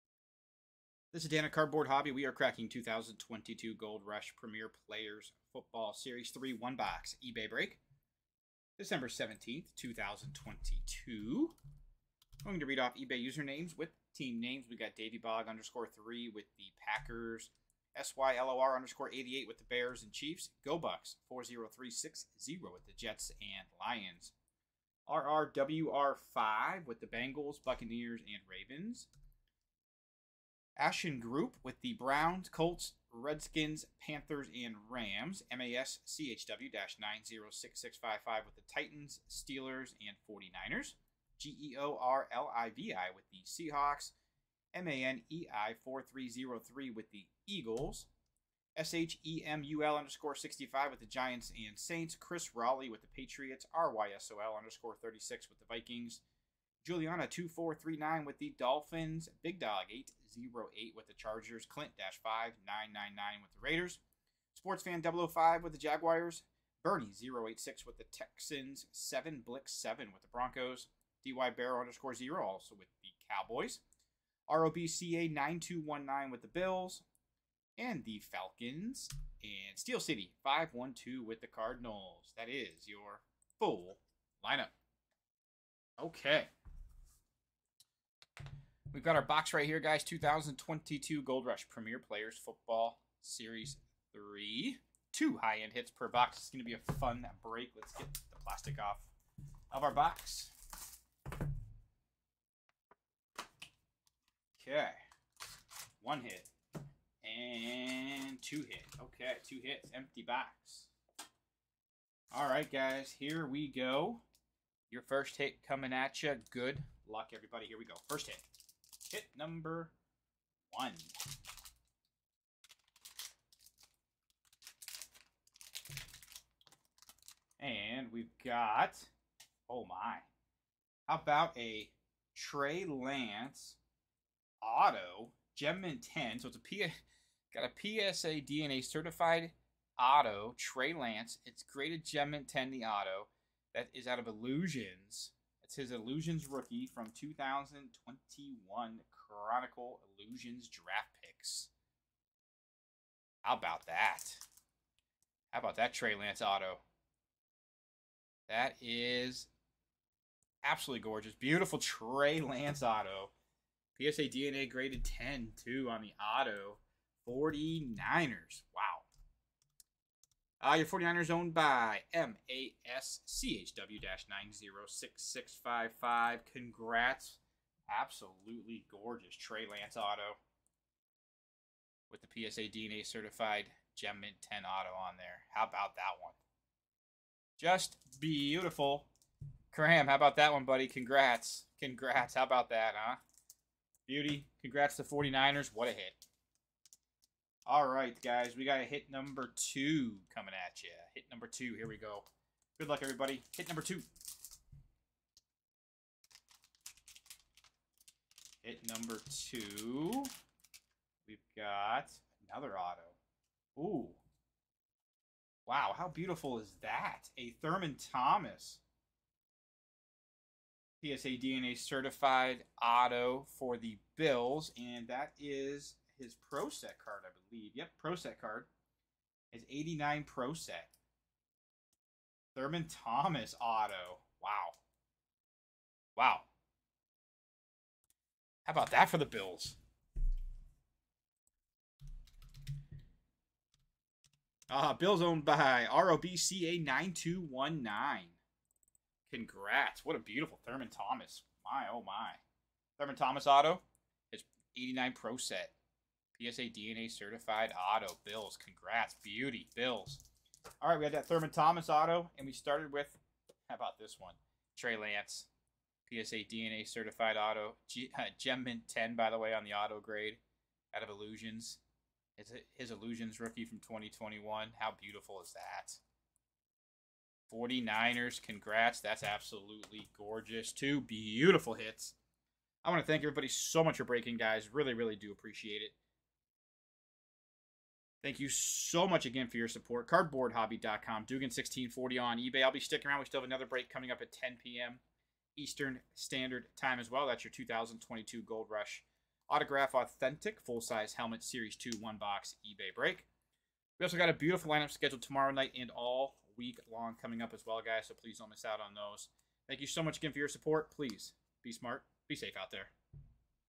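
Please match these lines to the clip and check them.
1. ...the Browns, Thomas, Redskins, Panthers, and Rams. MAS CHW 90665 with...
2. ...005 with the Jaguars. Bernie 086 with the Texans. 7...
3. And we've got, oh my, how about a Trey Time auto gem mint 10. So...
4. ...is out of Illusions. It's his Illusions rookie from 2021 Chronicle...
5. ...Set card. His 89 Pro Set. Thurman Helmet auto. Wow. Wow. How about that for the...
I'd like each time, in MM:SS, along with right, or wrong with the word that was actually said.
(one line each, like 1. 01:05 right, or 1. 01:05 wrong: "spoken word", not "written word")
1. 00:31 wrong: "Colts", not "Thomas"
2. 01:05 right
3. 02:07 wrong: "Lance", not "Time"
4. 02:23 right
5. 03:48 wrong: "Thomas", not "Helmet".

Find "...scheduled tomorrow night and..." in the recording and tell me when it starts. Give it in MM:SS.
05:04.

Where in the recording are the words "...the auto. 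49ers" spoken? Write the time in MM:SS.
02:46.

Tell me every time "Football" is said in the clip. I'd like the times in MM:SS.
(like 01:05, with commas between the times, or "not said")
00:05, 01:32.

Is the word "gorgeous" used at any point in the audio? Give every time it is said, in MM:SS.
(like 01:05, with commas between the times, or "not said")
02:41, 02:58, 04:40.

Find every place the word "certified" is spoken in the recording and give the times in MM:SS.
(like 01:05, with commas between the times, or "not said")
02:18, 03:03, 03:41, 04:17, 04:26.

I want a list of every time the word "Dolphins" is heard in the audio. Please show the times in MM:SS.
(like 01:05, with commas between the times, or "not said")
00:58.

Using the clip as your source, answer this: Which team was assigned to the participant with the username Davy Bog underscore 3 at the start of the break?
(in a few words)
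Packers.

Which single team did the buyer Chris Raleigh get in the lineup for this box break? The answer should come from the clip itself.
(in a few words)
Patriots.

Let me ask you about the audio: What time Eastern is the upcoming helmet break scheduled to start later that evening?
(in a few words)
10 p.m.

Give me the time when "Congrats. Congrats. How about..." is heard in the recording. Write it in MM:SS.
03:10.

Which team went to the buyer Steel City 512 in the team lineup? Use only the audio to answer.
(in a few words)
Cardinals.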